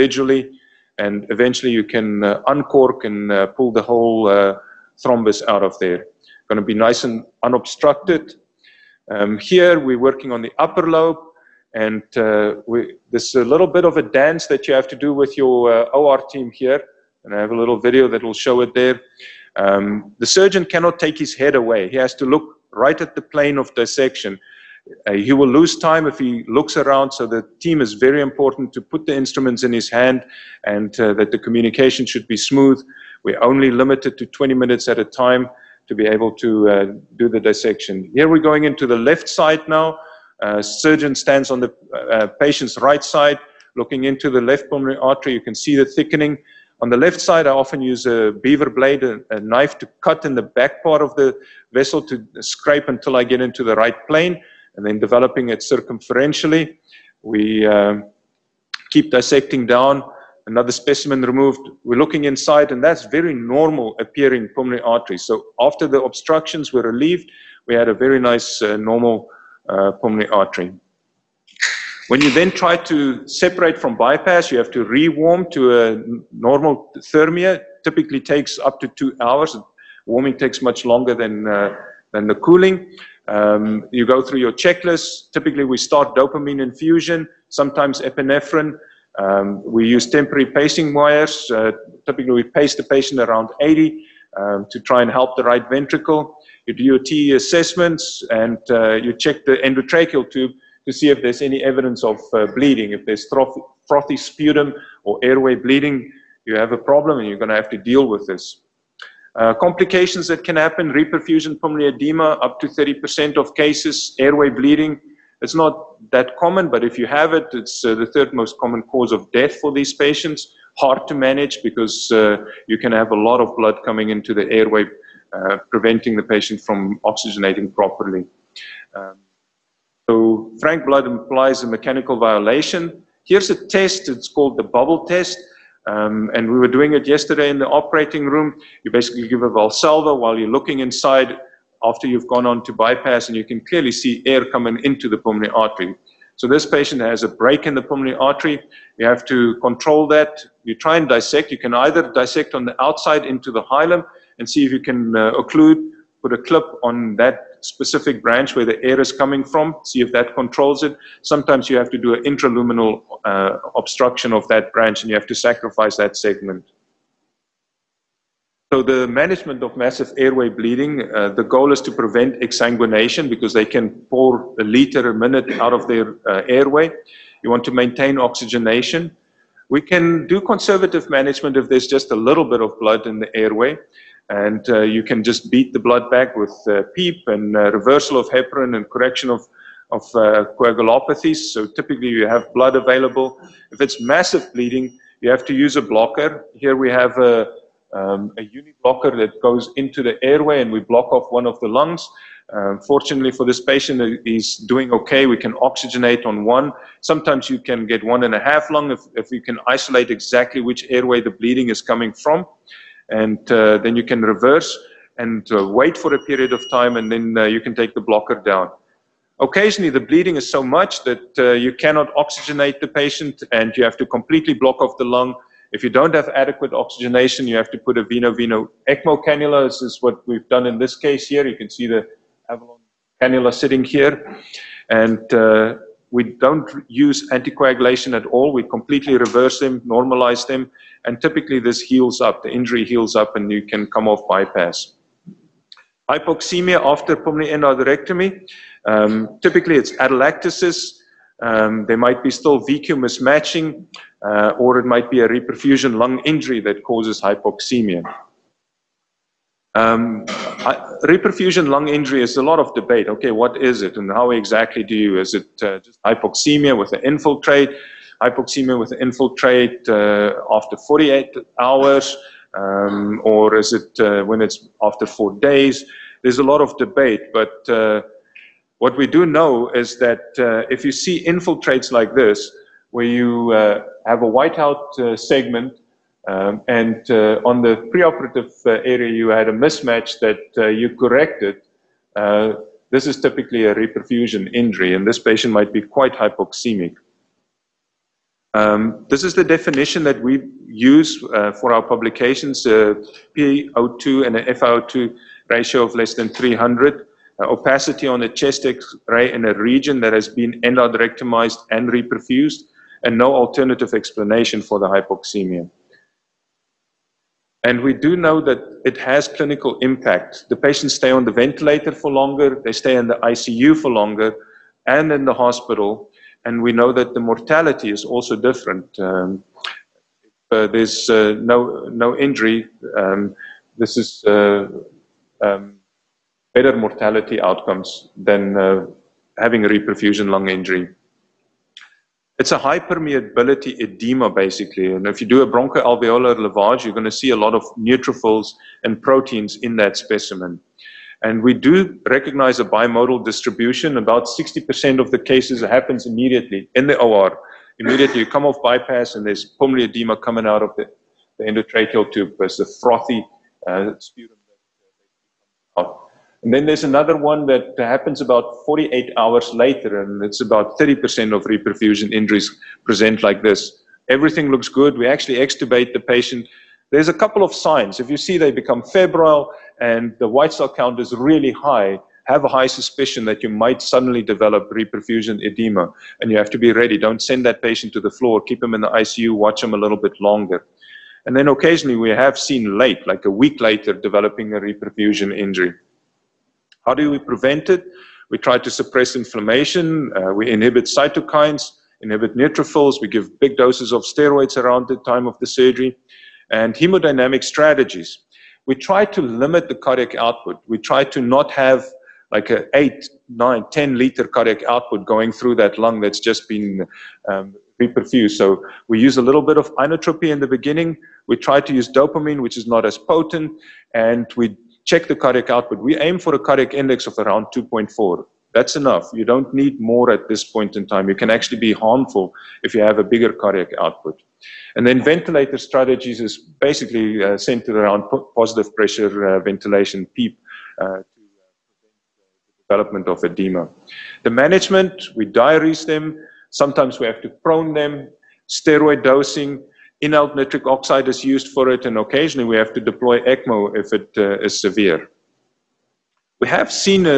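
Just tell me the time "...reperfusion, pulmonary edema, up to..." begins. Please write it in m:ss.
1:50.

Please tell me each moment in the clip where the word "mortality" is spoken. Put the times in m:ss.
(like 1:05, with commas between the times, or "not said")
5:27, 5:36.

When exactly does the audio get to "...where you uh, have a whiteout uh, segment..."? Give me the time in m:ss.
4:42.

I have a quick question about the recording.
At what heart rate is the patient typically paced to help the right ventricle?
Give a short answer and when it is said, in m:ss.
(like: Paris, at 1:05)
80, at 1:33.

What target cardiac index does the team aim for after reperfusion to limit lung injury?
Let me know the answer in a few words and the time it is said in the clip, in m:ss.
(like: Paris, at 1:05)
2.4, at 7:07.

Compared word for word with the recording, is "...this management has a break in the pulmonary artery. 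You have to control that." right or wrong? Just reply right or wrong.
wrong.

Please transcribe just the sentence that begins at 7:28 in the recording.
Steroid dosing, inhaled nitric oxide is used for it, and occasionally we have to deploy ECMO if it uh, is severe.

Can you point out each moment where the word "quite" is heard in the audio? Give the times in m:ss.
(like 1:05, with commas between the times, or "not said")
4:55.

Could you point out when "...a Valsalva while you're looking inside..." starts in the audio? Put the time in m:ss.
2:19.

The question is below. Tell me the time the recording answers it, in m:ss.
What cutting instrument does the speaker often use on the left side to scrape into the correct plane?
0:48.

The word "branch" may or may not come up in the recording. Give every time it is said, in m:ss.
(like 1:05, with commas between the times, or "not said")
2:38, 2:44.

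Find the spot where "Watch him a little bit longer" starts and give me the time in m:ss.
6:29.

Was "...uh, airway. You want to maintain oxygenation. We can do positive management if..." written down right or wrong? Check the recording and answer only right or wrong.
wrong.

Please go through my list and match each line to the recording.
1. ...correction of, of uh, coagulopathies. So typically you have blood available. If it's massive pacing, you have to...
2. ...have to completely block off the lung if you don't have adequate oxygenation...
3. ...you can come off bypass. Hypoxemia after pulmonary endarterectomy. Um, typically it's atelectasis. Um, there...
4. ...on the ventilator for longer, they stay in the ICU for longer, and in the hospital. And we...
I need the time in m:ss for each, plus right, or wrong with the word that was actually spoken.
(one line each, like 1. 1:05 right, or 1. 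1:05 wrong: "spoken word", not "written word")
1. 3:08 wrong: "bleeding", not "pacing"
2. 3:43 right
3. 4:03 right
4. 5:21 right.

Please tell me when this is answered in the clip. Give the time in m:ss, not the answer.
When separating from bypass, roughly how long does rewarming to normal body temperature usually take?
1:18.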